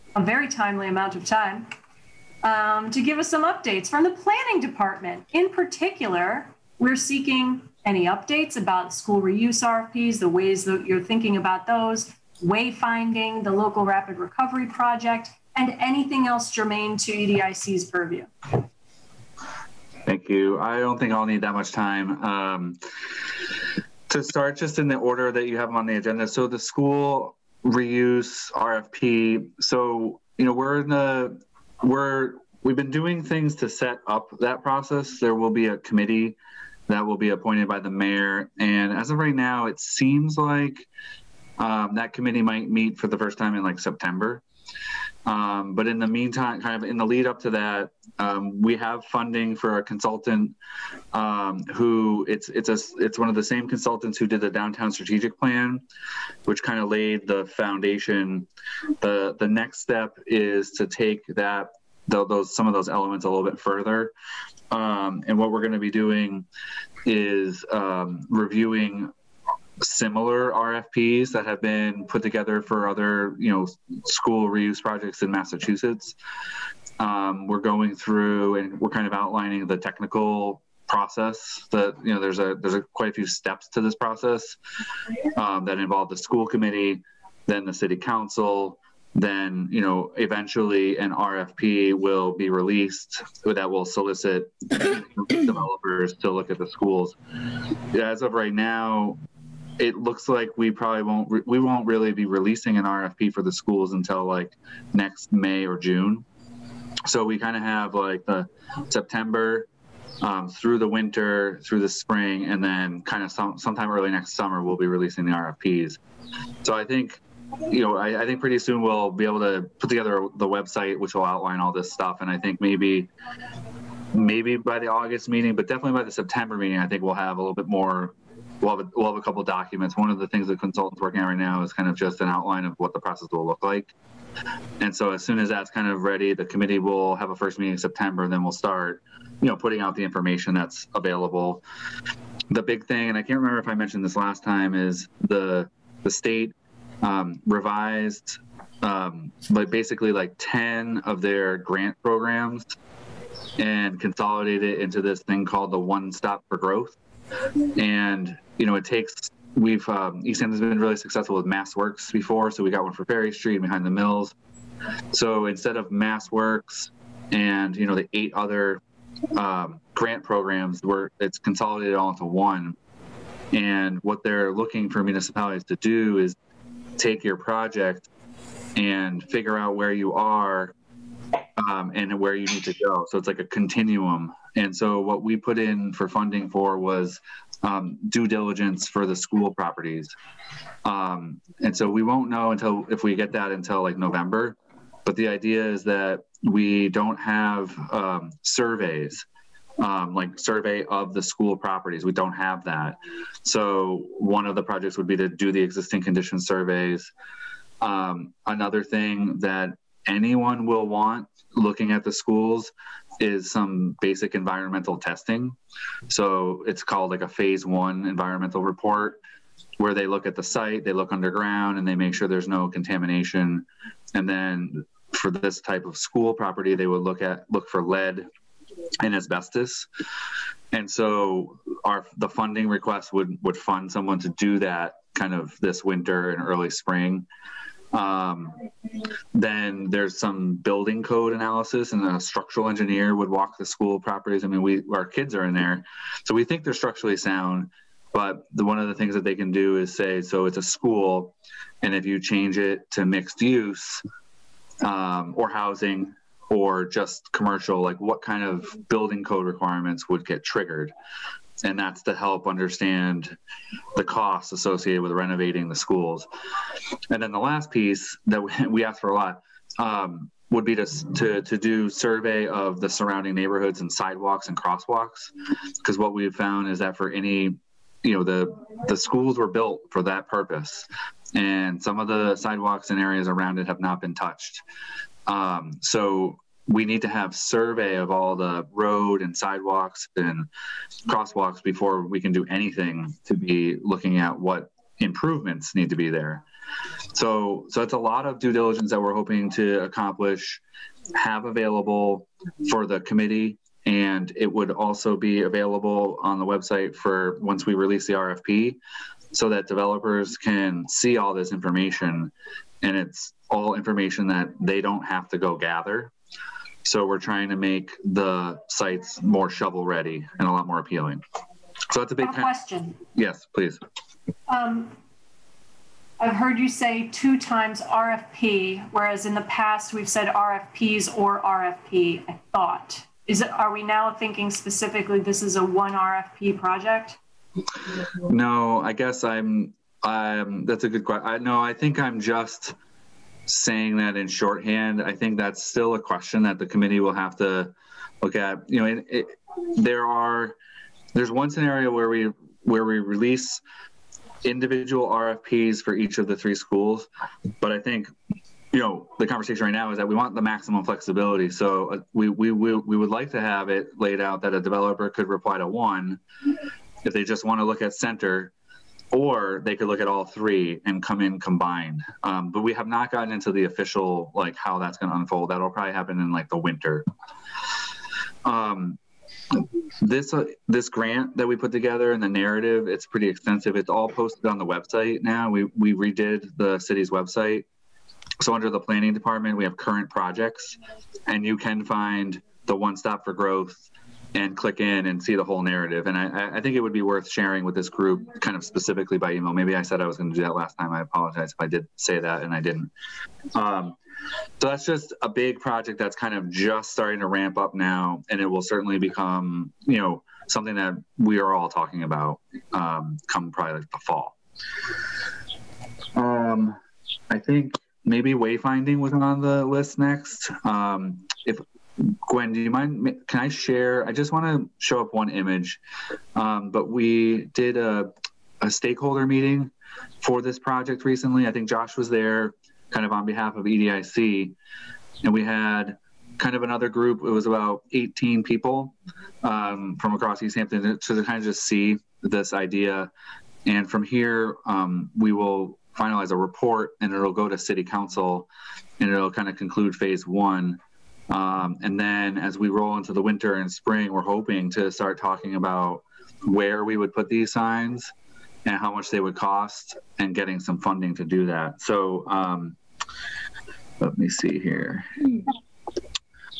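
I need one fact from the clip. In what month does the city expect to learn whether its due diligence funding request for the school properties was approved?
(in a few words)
November.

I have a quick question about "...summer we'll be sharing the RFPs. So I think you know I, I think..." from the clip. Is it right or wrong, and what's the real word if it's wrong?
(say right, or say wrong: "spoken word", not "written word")
wrong: "releasing", not "sharing".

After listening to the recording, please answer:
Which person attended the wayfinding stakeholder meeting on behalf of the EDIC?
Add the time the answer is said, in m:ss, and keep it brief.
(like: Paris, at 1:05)
Josh, at 7:11.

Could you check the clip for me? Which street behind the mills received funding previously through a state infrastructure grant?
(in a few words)
Ferry Street.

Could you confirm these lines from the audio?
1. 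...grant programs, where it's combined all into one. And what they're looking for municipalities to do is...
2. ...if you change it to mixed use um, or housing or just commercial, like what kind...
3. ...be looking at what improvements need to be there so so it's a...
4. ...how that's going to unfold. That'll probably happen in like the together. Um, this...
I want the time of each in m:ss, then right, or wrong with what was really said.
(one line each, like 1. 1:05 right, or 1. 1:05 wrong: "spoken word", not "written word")
1. 2:49 wrong: "consolidated", not "combined"
2. 4:11 right
3. 4:53 right
4. 6:14 wrong: "winter", not "together".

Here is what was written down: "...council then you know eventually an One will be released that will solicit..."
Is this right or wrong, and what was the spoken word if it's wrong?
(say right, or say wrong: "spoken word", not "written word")
wrong: "RFP", not "One".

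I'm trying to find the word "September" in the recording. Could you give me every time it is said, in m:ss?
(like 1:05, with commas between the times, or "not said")
0:43, 1:48, 2:06, 2:17.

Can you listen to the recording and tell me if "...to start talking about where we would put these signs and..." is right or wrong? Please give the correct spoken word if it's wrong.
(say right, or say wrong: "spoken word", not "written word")
right.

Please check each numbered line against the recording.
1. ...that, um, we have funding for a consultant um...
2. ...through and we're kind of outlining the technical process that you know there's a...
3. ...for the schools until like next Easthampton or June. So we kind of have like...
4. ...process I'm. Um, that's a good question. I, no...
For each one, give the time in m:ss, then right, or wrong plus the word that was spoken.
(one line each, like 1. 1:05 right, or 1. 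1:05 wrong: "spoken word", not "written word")
1. 0:47 right
2. 1:17 right
3. 1:43 wrong: "May", not "Easthampton"
4. 5:38 wrong: "guess", not "process".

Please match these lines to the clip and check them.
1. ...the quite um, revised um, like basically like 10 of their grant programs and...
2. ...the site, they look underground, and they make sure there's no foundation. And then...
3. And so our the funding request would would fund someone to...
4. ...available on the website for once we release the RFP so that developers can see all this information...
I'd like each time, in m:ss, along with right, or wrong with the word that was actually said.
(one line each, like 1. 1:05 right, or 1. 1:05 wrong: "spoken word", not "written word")
1. 2:26 wrong: "state", not "quite"
2. 3:40 wrong: "contamination", not "foundation"
3. 3:50 right
4. 5:05 right.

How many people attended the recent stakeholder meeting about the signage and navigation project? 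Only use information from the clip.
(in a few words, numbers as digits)
18.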